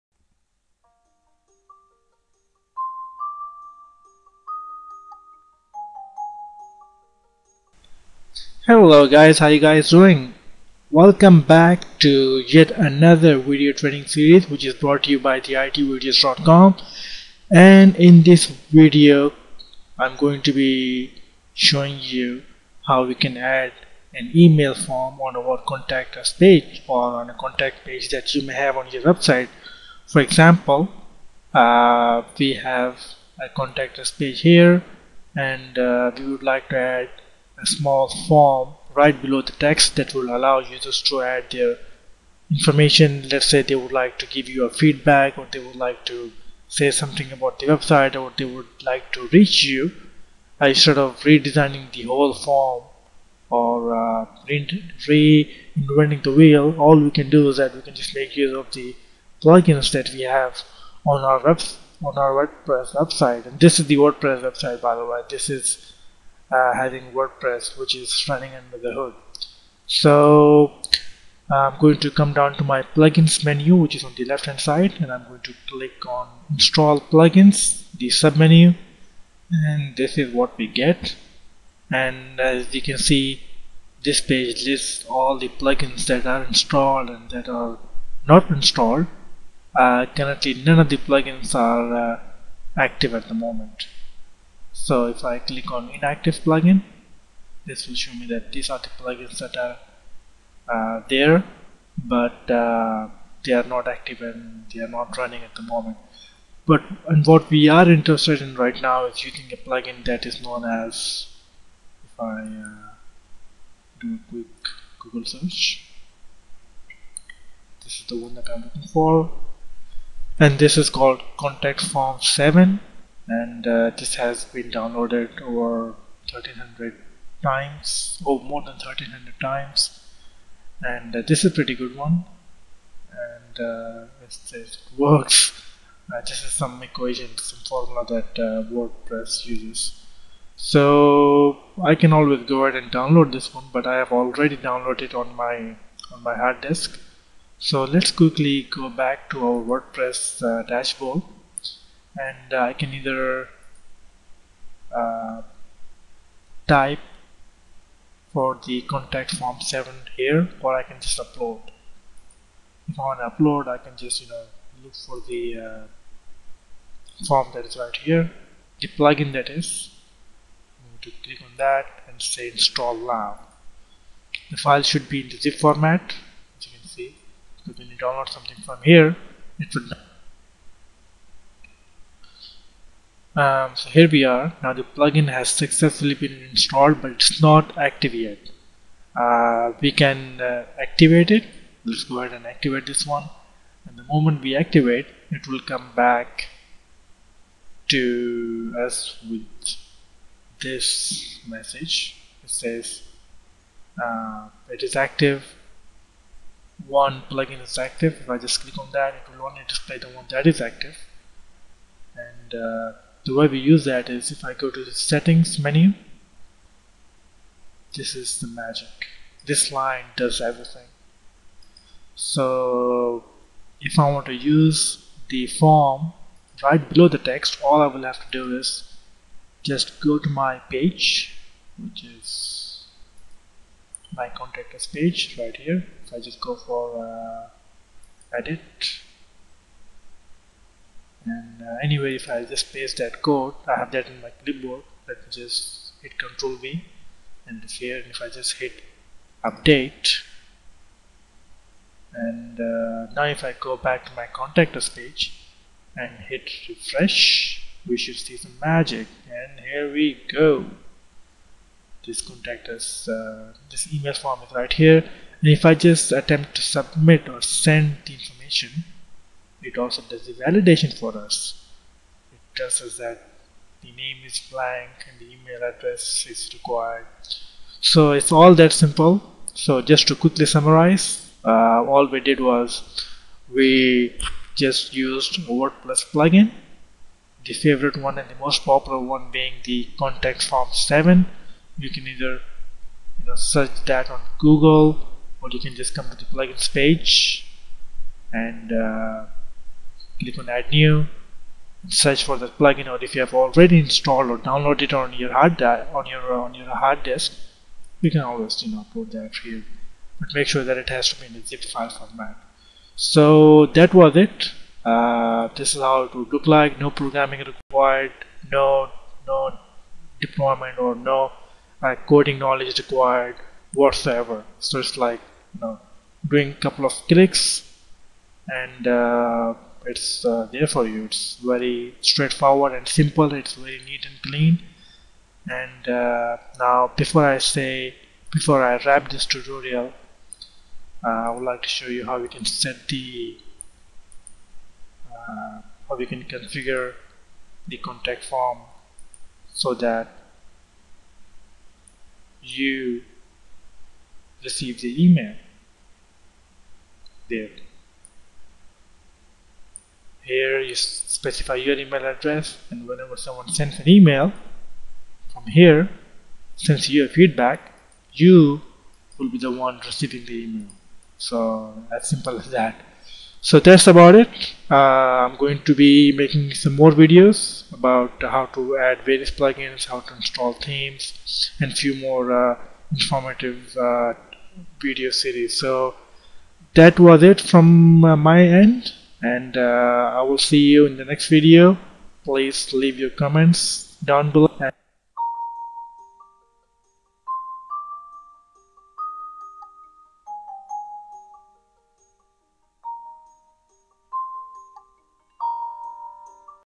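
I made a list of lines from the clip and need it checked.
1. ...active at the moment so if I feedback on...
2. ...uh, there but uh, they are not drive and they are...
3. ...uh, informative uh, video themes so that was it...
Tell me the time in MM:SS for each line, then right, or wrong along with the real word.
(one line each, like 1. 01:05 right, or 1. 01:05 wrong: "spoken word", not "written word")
1. 01:32 wrong: "click", not "feedback"
2. 01:40 wrong: "active", not "drive"
3. 06:22 wrong: "series", not "themes".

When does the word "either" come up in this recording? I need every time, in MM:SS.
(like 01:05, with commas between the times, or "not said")
02:32, 04:52.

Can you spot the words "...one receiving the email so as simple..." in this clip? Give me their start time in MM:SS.
06:09.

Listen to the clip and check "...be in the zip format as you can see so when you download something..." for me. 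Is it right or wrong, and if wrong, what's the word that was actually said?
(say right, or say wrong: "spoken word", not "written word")
right.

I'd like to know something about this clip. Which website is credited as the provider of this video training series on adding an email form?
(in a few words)
theitvideos.com.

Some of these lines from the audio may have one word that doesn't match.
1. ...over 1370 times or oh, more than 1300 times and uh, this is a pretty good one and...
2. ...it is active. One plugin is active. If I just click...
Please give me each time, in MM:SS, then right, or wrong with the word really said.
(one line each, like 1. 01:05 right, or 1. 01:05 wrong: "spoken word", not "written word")
1. 02:05 wrong: "1300", not "1370"
2. 03:24 right.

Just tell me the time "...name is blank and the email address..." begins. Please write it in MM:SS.
04:33.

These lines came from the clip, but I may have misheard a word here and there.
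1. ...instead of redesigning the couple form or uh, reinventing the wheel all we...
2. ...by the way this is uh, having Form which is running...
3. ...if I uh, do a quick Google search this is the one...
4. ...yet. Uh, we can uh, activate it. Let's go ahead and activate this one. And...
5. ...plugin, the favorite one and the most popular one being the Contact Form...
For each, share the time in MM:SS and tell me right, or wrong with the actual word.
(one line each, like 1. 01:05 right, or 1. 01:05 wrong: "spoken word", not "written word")
1. 00:50 wrong: "whole", not "couple"
2. 01:04 wrong: "WordPress", not "Form"
3. 01:52 right
4. 03:08 right
5. 04:46 right.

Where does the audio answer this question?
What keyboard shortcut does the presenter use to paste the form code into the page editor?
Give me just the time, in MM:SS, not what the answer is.
04:06.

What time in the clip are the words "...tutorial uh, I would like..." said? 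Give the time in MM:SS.
05:39.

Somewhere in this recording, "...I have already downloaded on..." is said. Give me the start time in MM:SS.
02:23.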